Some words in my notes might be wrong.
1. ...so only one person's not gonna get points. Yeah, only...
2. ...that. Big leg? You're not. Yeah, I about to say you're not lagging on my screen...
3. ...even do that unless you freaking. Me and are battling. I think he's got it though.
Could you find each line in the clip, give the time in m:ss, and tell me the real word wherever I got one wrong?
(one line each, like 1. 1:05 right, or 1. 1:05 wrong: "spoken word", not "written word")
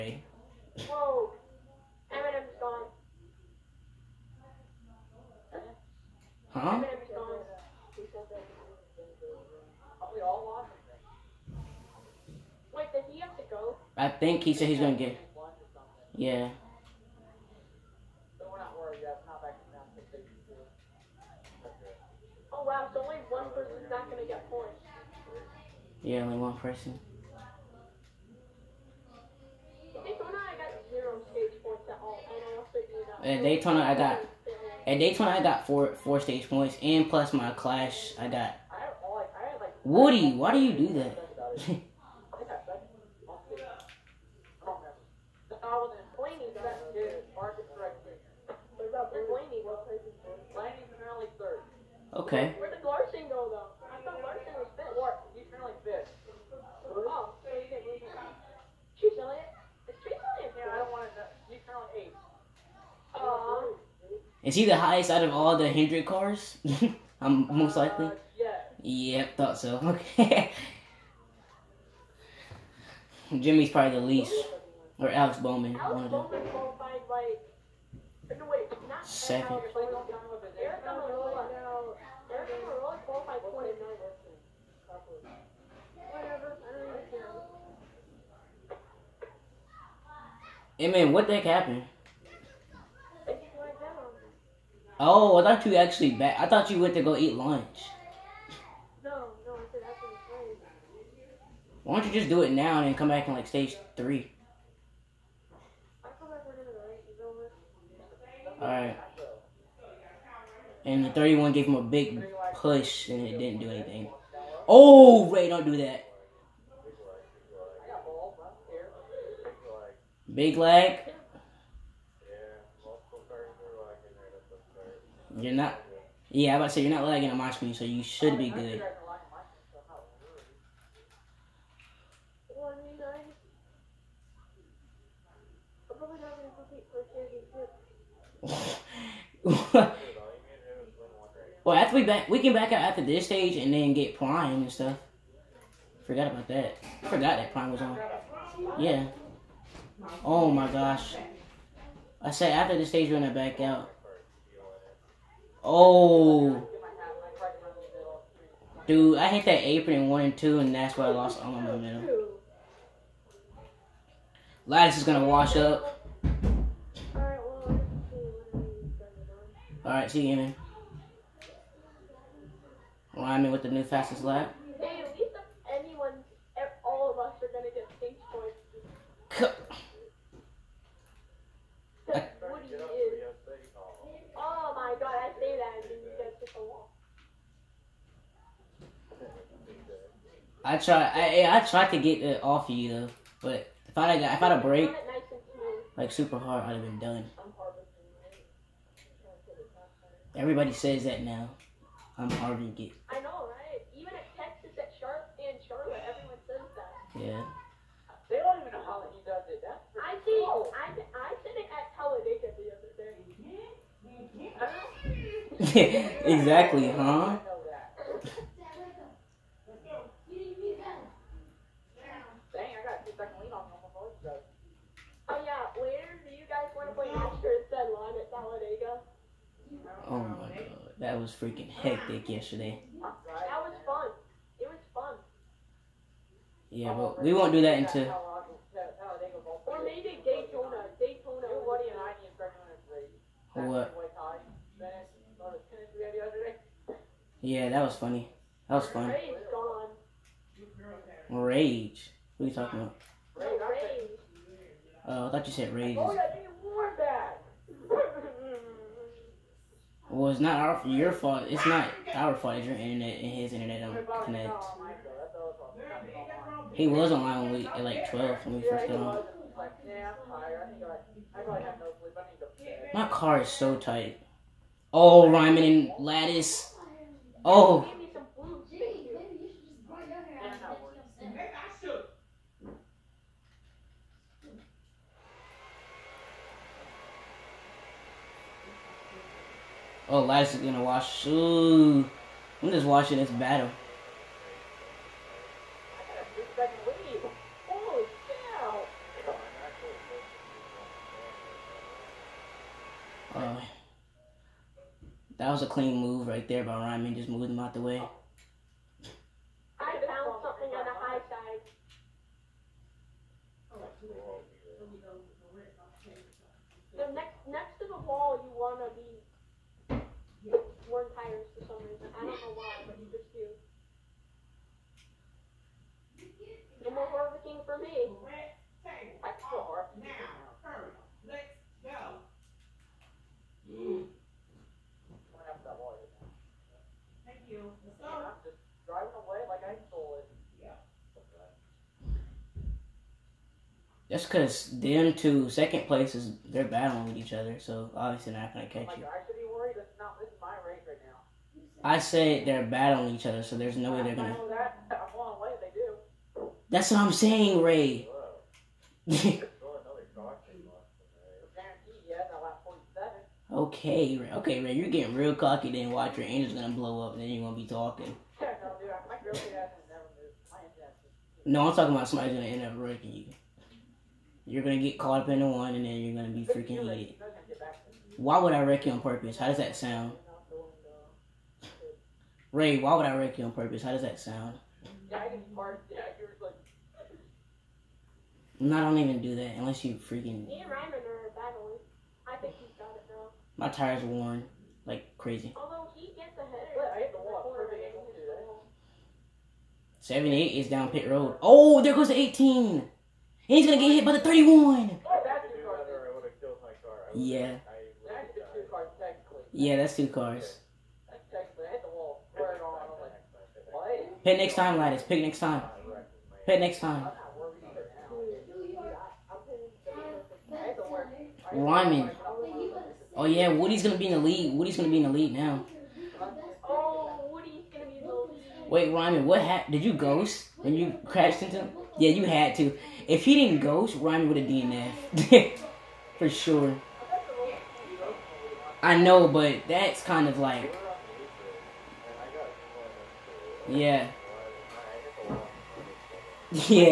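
1. 0:22 right
2. 1:55 right
3. 6:28 right.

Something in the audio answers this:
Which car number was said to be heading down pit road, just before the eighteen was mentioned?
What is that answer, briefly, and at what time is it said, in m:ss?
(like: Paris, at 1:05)
78, at 6:40.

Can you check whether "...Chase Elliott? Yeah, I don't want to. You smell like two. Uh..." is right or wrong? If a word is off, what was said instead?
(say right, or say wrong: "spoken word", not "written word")
wrong: "eight", not "two".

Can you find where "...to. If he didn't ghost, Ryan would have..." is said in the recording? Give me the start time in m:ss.
7:12.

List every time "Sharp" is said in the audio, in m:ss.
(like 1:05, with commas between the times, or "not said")
3:24.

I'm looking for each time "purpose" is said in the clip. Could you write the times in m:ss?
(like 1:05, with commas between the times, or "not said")
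6:19, 6:23.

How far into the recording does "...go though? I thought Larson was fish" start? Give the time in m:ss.
0:53.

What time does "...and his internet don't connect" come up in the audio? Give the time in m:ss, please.
4:23.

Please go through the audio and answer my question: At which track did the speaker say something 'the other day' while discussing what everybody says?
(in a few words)
Talladega.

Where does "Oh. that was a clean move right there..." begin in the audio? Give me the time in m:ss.
5:03.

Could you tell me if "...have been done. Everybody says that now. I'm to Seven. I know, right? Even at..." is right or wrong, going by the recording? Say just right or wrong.
wrong.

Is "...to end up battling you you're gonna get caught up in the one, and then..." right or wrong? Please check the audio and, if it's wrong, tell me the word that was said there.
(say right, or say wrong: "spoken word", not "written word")
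wrong: "breaking", not "battling".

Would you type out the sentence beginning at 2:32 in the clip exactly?
I said after the stage going I back out.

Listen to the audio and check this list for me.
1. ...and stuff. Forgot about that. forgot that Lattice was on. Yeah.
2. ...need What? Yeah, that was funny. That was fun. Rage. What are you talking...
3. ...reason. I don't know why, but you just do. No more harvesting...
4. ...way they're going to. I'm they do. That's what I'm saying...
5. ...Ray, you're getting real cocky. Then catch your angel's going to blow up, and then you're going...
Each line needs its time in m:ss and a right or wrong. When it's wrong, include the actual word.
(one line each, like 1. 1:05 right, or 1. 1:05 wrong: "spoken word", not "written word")
1. 2:24 wrong: "Prime", not "Lattice"
2. 4:02 right
3. 5:21 right
4. 5:53 right
5. 6:04 wrong: "watch", not "catch".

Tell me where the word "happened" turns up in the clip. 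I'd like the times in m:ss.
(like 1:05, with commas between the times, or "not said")
1:31, 7:09.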